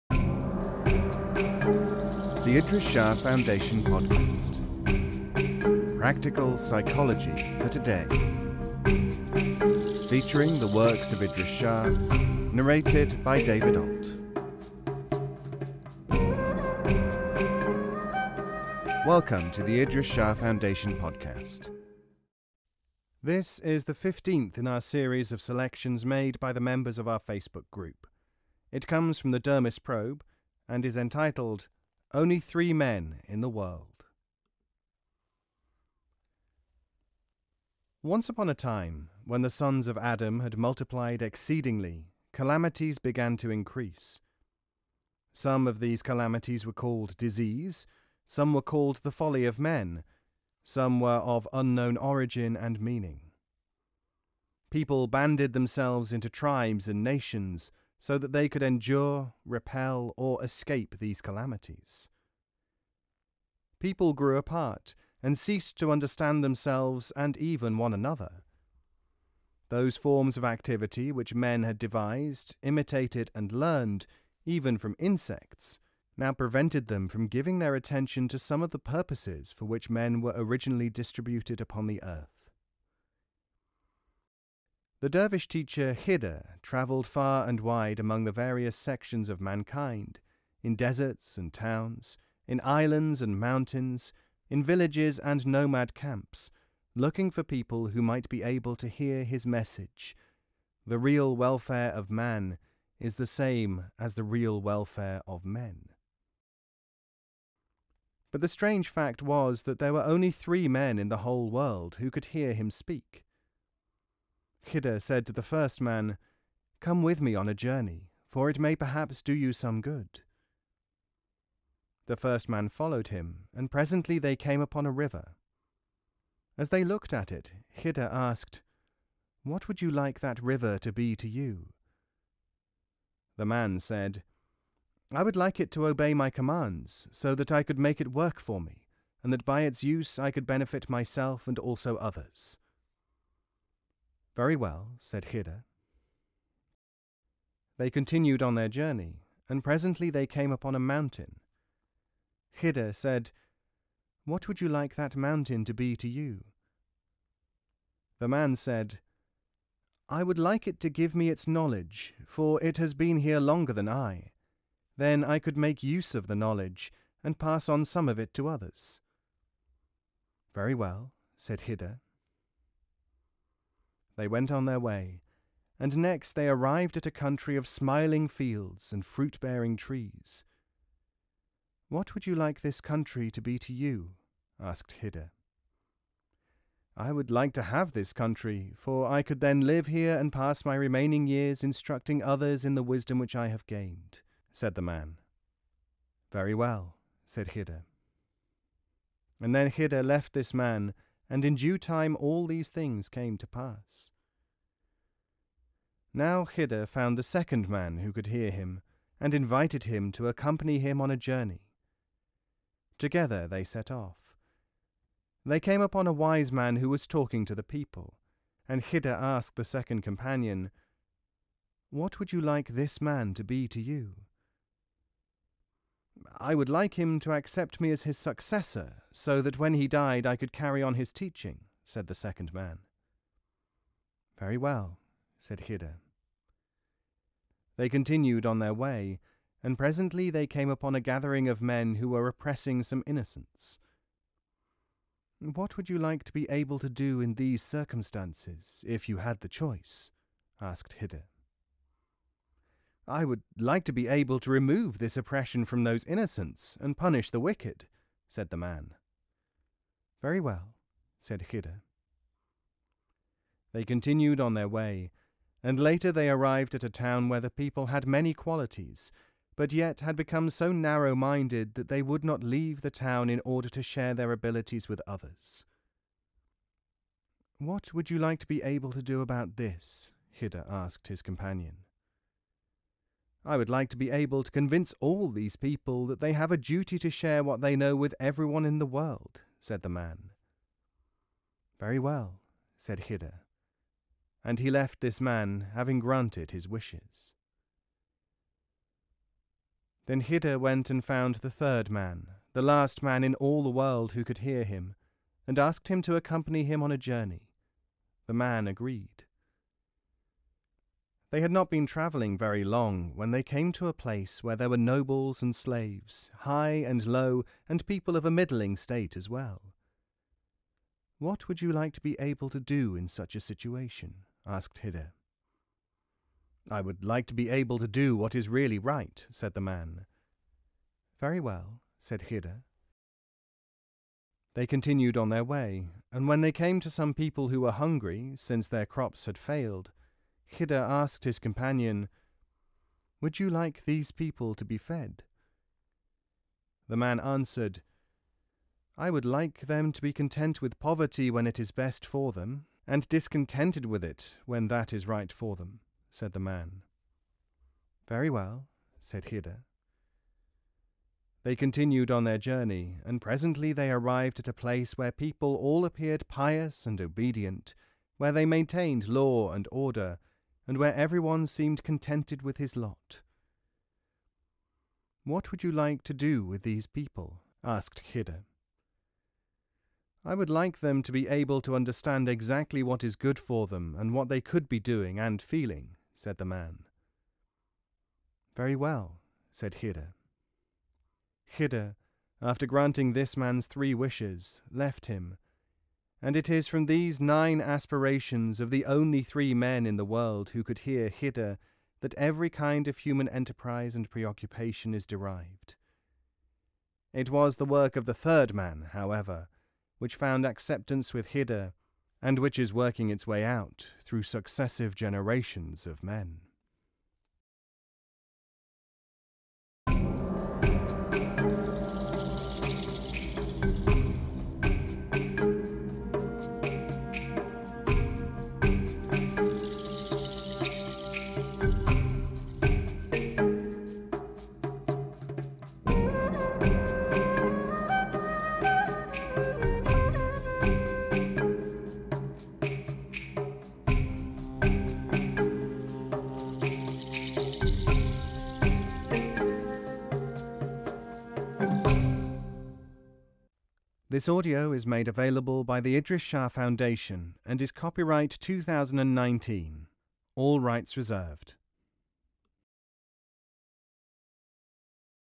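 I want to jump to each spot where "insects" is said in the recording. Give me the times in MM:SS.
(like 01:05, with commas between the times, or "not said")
01:14.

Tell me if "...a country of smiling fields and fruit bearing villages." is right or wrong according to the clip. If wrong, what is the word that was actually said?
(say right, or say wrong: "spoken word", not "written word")
wrong: "trees", not "villages".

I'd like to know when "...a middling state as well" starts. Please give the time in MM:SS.
05:18.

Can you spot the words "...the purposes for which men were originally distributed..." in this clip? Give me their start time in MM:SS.
01:18.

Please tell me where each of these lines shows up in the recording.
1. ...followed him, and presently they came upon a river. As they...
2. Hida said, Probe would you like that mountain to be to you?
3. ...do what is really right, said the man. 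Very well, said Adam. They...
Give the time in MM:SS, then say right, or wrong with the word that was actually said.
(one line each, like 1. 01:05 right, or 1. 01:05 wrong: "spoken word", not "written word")
1. 02:02 right
2. 02:32 wrong: "What", not "Probe"
3. 05:27 wrong: "Hida", not "Adam".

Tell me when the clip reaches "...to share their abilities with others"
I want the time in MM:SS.
04:33.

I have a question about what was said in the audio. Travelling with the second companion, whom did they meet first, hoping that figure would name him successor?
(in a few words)
A wise man.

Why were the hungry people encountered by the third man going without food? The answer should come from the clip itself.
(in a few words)
Their crops had failed.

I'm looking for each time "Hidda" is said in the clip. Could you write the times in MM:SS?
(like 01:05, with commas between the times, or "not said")
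03:26, 03:38.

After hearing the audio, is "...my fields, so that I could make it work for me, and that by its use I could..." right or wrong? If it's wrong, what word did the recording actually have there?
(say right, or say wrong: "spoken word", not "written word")
wrong: "commands", not "fields".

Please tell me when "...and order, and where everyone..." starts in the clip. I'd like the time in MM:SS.
06:09.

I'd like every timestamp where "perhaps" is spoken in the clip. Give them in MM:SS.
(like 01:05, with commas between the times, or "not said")
01:58.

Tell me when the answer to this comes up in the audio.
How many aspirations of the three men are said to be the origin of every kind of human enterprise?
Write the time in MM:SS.
06:37.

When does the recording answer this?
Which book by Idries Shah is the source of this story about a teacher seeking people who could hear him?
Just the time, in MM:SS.
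00:29.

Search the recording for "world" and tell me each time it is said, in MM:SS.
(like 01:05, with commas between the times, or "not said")
00:33, 01:51, 04:48, 05:03, 06:40.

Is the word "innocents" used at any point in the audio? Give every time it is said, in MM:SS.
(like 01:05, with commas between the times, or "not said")
04:03, 04:16.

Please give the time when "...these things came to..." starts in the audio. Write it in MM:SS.
03:22.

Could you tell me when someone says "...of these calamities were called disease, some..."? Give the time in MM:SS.
00:45.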